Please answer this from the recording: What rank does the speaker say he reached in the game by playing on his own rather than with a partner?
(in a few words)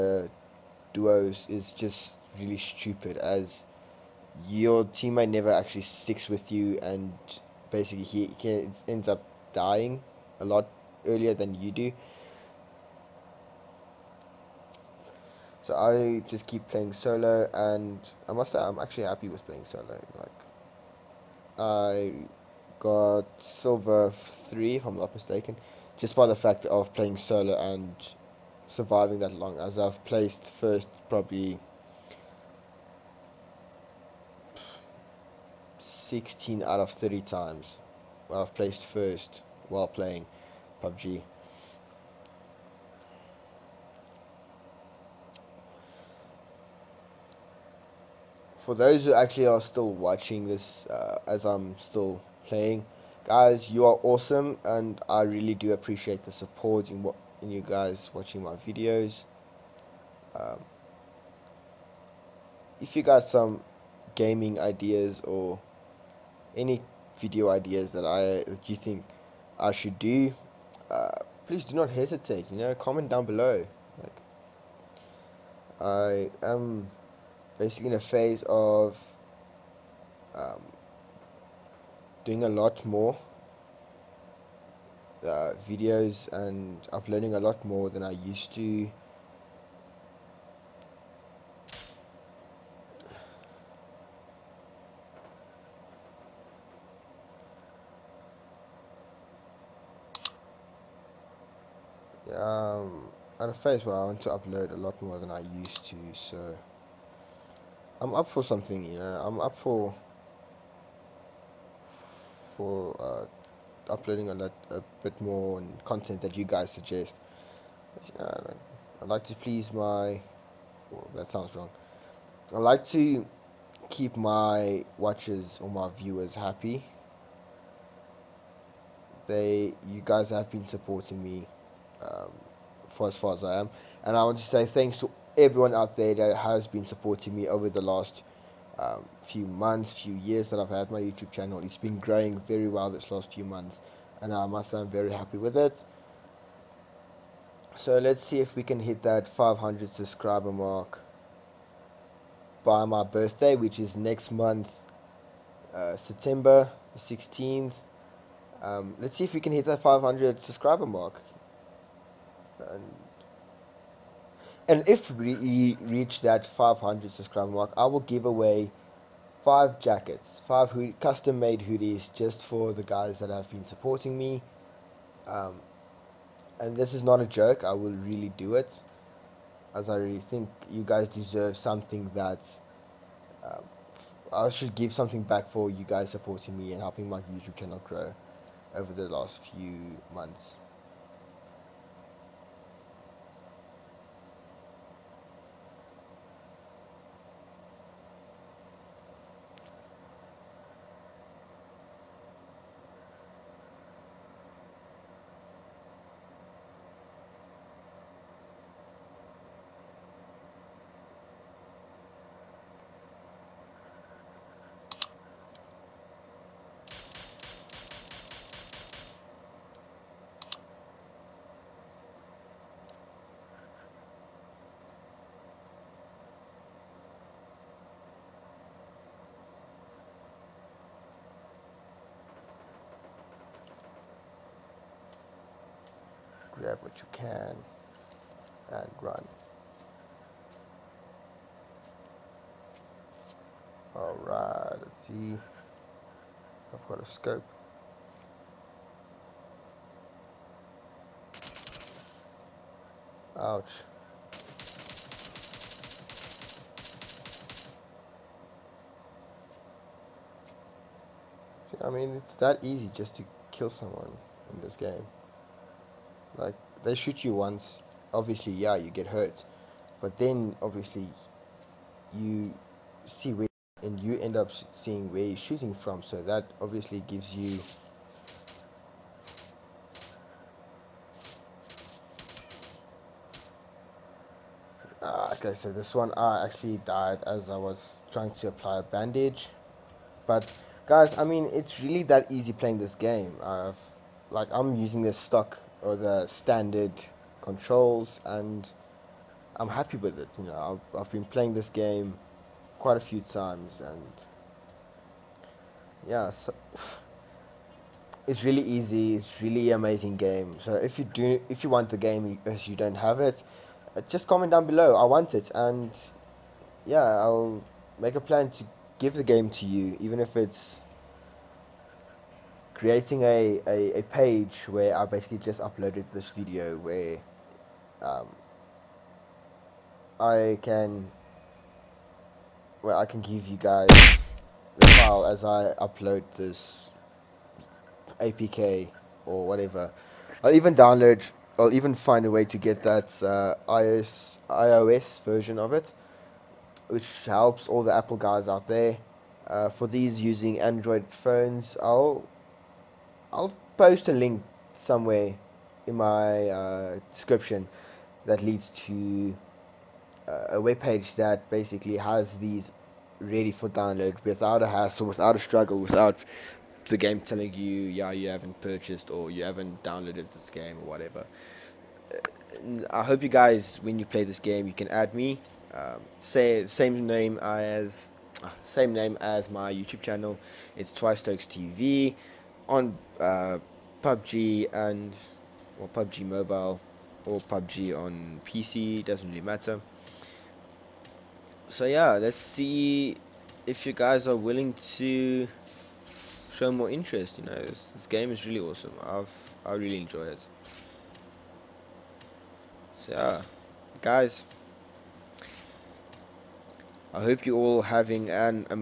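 Silver 3.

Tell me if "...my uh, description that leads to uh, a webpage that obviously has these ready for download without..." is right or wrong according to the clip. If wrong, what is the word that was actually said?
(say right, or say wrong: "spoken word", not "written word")
wrong: "basically", not "obviously".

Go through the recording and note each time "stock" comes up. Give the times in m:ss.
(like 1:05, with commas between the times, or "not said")
4:55.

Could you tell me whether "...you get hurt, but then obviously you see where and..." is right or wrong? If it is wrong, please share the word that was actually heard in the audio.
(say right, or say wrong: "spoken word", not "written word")
right.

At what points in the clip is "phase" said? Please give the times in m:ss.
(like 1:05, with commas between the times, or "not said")
1:18, 1:43.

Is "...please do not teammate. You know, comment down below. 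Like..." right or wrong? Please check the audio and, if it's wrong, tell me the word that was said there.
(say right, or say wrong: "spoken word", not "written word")
wrong: "hesitate", not "teammate".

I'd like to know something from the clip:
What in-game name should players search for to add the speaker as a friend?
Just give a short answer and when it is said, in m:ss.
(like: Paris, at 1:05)
Twice Stokes TV, at 6:20.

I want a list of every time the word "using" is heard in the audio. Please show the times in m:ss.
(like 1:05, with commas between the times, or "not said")
4:54, 5:50.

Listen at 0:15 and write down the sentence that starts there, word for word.
So I just keep playing solo, and I must say I'm actually happy with playing solo.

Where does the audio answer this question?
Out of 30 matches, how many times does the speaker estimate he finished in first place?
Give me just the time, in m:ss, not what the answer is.
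0:35.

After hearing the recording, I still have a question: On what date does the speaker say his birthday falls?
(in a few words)
September 16th.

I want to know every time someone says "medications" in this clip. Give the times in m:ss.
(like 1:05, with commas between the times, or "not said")
not said.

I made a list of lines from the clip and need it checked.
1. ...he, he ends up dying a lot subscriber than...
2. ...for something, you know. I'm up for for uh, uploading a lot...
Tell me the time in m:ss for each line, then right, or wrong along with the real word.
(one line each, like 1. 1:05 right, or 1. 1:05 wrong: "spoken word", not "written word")
1. 0:08 wrong: "earlier", not "subscriber"
2. 1:48 right.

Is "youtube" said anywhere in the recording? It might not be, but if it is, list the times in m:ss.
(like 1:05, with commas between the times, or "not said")
2:21, 3:07, 6:19.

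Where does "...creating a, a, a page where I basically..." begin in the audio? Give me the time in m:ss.
5:22.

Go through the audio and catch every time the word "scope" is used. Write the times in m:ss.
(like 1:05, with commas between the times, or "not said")
4:07.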